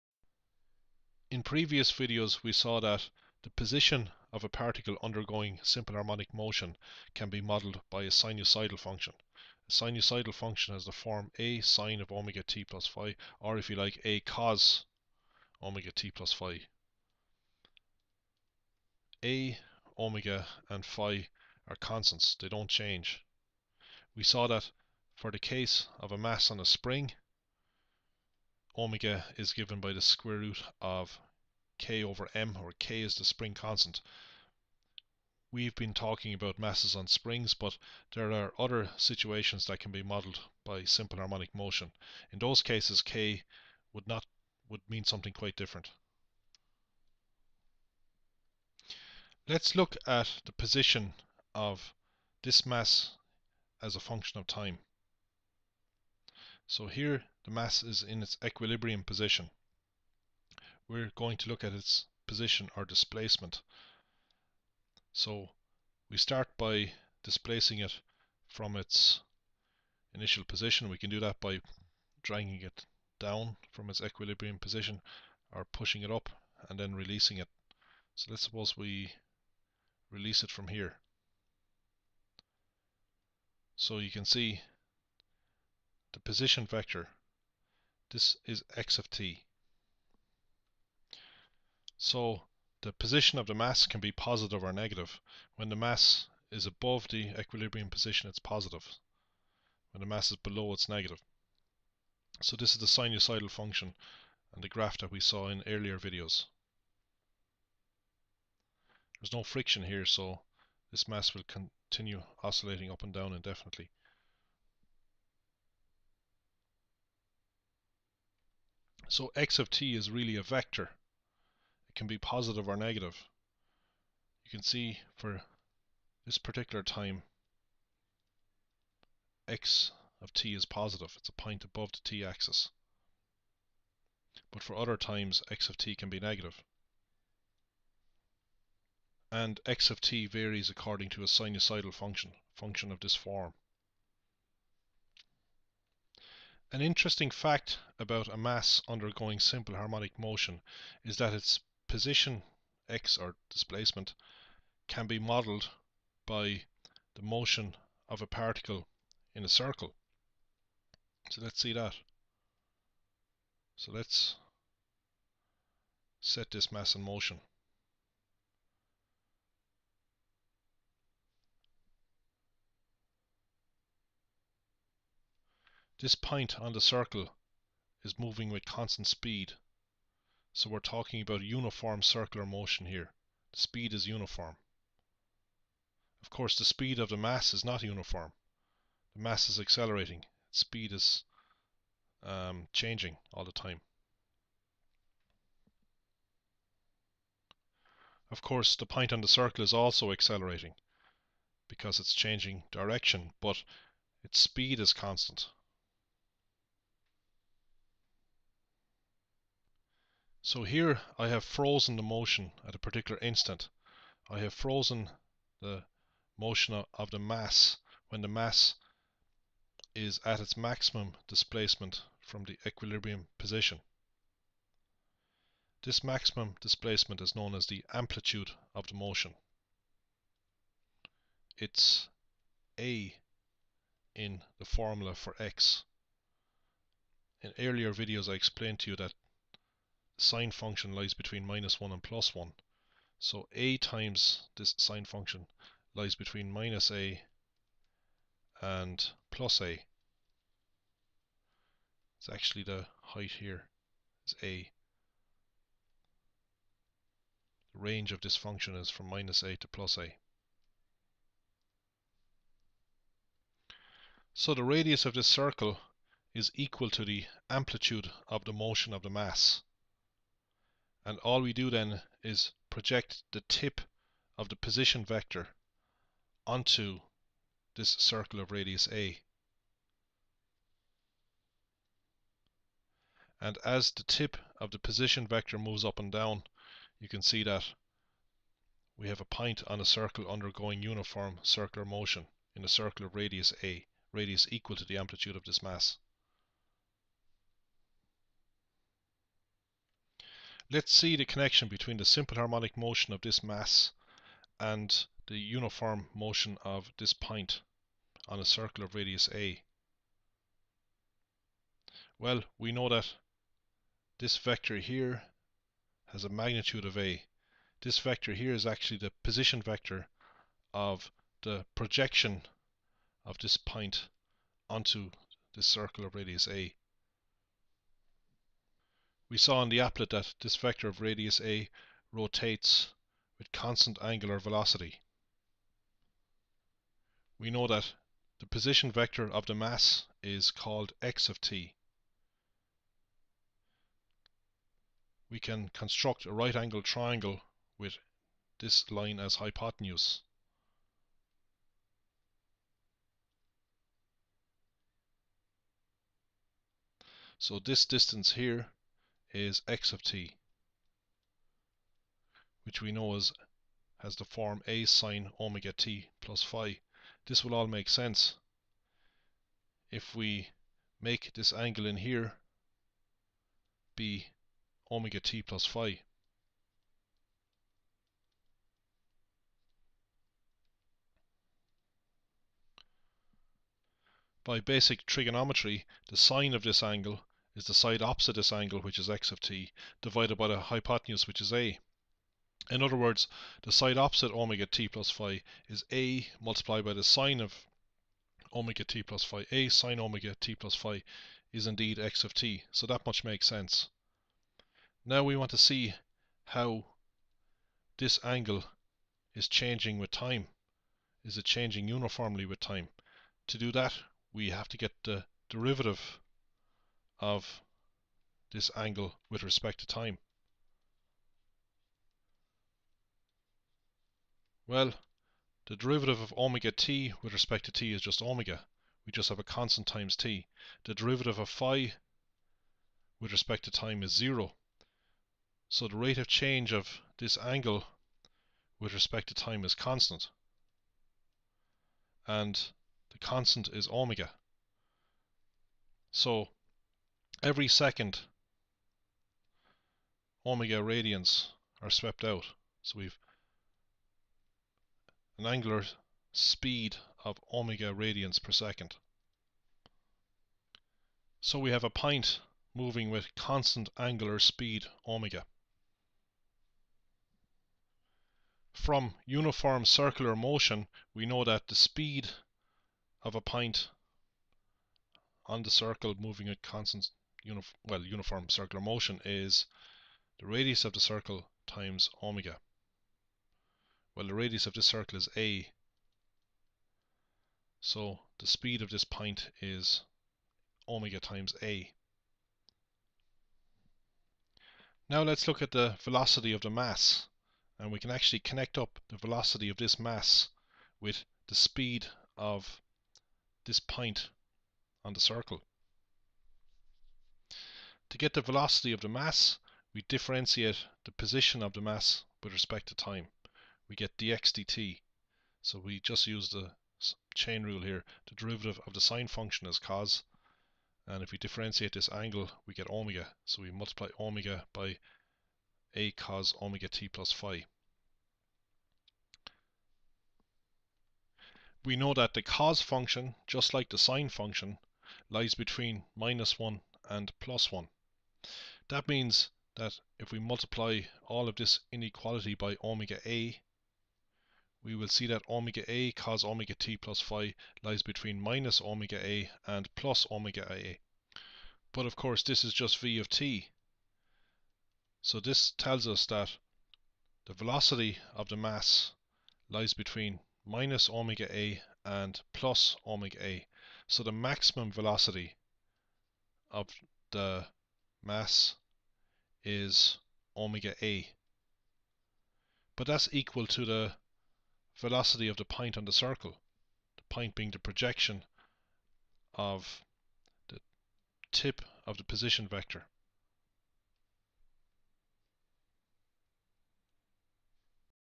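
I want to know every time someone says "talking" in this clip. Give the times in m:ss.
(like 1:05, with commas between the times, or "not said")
0:35, 3:00.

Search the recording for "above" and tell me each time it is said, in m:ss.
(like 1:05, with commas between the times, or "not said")
1:36, 2:11.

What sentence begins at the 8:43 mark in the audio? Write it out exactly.
So we multiply omega by a cos omega t plus phi.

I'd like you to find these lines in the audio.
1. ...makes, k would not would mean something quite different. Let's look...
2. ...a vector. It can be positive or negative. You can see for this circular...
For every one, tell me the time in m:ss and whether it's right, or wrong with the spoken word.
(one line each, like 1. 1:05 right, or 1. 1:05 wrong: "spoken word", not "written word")
1. 0:42 wrong: "cases", not "makes"
2. 2:00 wrong: "particular", not "circular".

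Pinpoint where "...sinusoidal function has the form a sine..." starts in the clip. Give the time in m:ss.
0:09.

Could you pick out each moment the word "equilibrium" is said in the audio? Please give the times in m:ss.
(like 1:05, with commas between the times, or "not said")
0:58, 1:13, 1:37, 3:42.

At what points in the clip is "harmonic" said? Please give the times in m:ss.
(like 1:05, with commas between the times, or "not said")
0:05, 0:41, 2:29, 5:02.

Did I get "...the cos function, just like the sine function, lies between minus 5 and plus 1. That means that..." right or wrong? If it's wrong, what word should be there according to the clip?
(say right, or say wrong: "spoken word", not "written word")
wrong: "1", not "5".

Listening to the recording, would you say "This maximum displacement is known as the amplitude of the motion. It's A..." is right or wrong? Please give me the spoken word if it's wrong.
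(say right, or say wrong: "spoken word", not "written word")
right.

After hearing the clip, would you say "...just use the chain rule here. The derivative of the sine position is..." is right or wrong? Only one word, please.
wrong.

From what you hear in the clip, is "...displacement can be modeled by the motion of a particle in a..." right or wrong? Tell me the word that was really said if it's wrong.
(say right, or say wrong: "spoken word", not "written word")
right.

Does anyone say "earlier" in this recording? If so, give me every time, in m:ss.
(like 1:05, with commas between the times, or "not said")
1:45, 3:57.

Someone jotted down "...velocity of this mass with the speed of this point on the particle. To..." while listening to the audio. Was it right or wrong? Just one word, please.
wrong.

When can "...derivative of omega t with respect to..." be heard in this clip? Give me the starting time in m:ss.
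7:05.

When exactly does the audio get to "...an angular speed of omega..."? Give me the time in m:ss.
7:35.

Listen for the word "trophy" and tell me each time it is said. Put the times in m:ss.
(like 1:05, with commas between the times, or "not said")
not said.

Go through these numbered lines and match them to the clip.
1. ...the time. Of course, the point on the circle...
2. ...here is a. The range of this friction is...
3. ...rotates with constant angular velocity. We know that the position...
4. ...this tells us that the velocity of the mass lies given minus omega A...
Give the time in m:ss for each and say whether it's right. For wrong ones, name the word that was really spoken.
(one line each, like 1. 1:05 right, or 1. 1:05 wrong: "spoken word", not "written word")
1. 3:13 right
2. 4:13 wrong: "function", not "friction"
3. 5:32 right
4. 9:15 wrong: "between", not "given".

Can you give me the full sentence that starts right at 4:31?
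And all we do then is project the tip of the position vector onto this circle of radius A.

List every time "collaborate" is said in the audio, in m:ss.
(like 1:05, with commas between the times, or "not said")
not said.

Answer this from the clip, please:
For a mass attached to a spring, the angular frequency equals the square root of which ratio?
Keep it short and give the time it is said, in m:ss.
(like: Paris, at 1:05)
k over m, at 0:31.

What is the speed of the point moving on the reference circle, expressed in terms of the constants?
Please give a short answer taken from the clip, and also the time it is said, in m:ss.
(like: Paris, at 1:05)
omega times a, at 8:10.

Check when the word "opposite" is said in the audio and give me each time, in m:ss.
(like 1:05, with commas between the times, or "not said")
6:28, 6:33.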